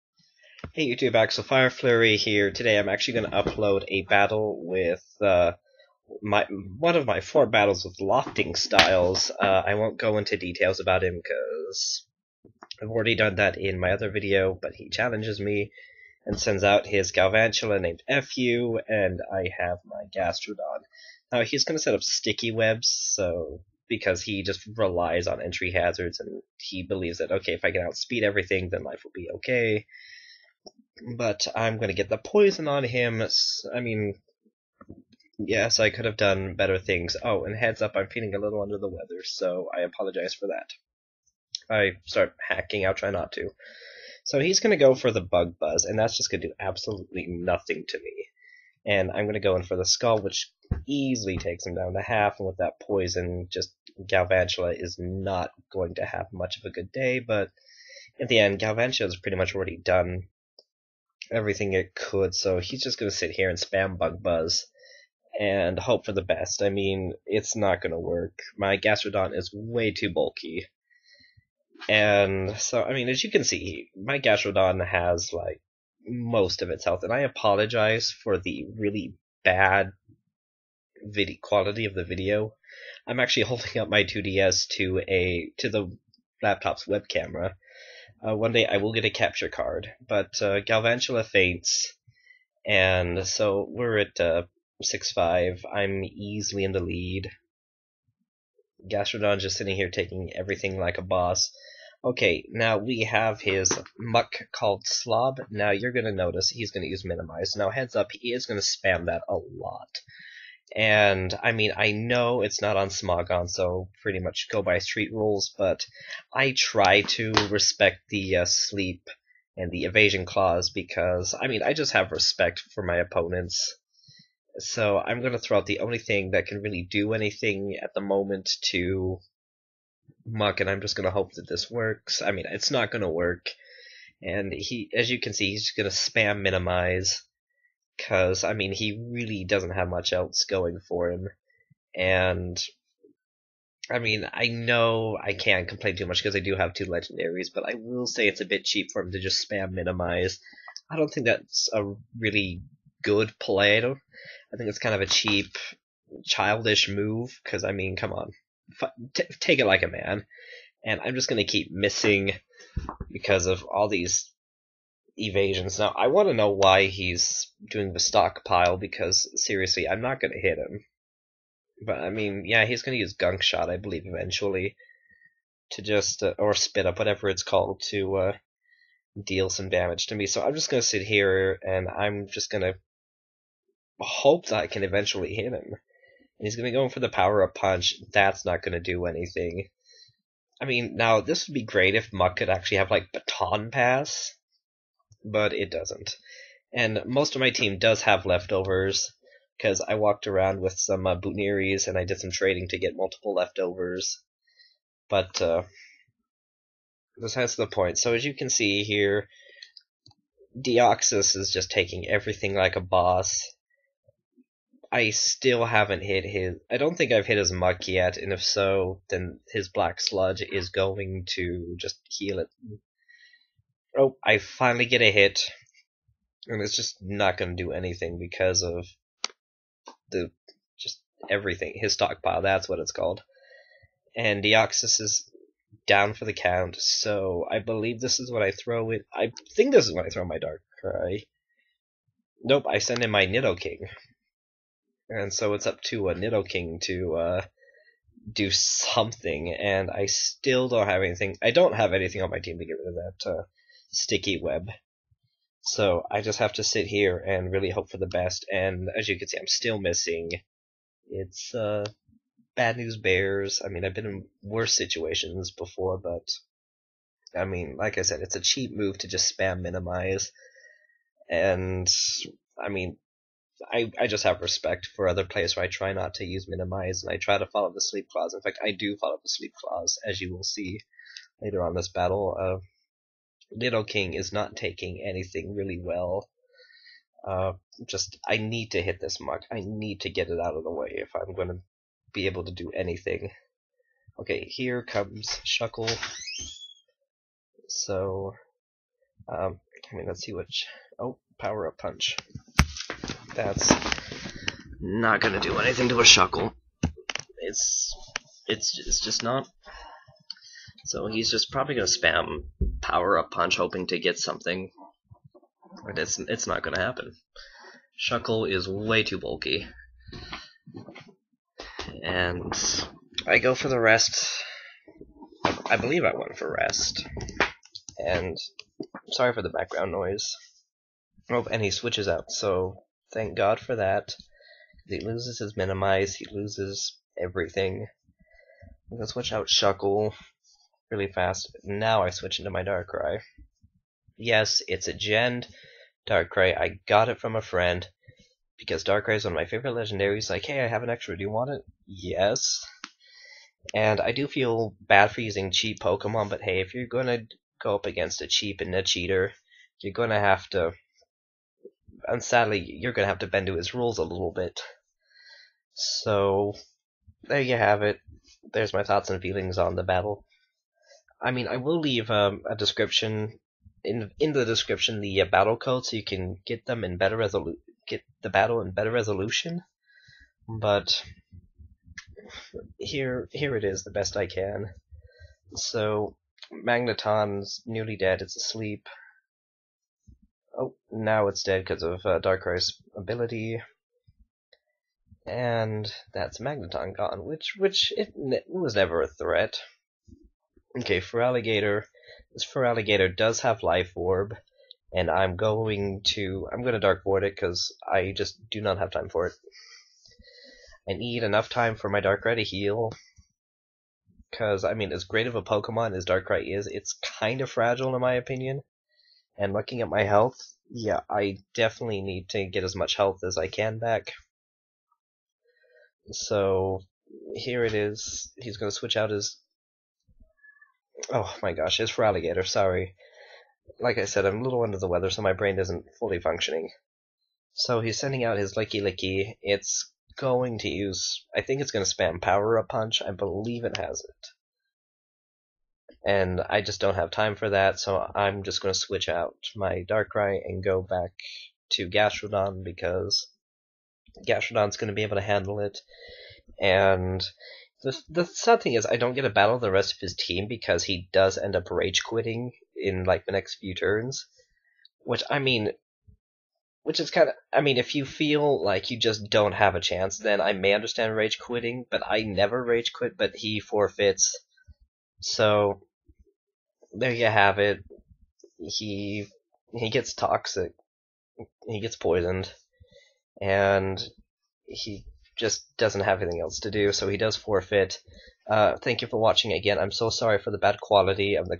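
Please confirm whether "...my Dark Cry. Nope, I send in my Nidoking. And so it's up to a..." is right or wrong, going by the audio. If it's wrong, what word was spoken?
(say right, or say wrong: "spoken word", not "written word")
right.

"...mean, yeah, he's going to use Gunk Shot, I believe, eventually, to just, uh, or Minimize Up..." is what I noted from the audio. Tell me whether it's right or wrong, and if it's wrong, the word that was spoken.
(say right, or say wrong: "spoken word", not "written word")
wrong: "Spit", not "Minimize".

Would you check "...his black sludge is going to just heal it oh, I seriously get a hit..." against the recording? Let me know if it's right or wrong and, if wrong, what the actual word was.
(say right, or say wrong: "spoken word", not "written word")
wrong: "finally", not "seriously".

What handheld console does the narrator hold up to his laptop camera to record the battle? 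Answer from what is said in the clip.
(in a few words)
2DS.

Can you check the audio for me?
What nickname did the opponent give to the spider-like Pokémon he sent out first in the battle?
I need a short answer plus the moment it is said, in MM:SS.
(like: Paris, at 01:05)
FU, at 00:18.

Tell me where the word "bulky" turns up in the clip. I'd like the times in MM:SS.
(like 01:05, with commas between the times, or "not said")
01:10, 05:19.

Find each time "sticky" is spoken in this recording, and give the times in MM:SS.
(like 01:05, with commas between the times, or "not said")
00:22, 04:13.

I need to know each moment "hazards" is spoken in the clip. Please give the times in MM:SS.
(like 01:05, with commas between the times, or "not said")
00:25.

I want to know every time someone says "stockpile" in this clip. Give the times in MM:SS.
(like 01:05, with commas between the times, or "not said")
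02:47, 03:51.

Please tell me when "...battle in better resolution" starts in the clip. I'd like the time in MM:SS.
06:18.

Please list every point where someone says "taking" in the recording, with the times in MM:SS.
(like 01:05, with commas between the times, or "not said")
01:39, 03:31, 04:44.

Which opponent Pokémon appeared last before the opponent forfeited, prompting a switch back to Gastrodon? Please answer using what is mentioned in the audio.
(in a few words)
Lickilicky.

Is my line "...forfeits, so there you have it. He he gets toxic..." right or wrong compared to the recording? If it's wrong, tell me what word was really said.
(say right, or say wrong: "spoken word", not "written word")
right.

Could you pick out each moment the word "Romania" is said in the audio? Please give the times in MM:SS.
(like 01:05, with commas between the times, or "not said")
not said.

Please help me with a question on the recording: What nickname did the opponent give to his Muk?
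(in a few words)
Slob.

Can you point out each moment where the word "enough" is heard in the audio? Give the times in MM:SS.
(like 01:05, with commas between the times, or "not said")
06:51.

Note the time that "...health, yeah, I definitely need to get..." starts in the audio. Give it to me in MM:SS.
07:00.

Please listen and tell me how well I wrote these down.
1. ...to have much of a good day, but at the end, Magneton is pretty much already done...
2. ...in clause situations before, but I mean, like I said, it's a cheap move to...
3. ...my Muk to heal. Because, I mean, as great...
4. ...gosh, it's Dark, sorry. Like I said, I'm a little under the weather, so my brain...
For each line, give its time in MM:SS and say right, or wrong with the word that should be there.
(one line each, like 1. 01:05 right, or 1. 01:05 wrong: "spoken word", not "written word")
1. 00:55 wrong: "Galvantula", not "Magneton"
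2. 04:24 wrong: "worse", not "clause"
3. 06:51 wrong: "Darkrai", not "Muk"
4. 07:11 wrong: "Feraligatr", not "Dark".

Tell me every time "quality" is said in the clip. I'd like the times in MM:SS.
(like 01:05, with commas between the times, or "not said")
01:21, 08:10.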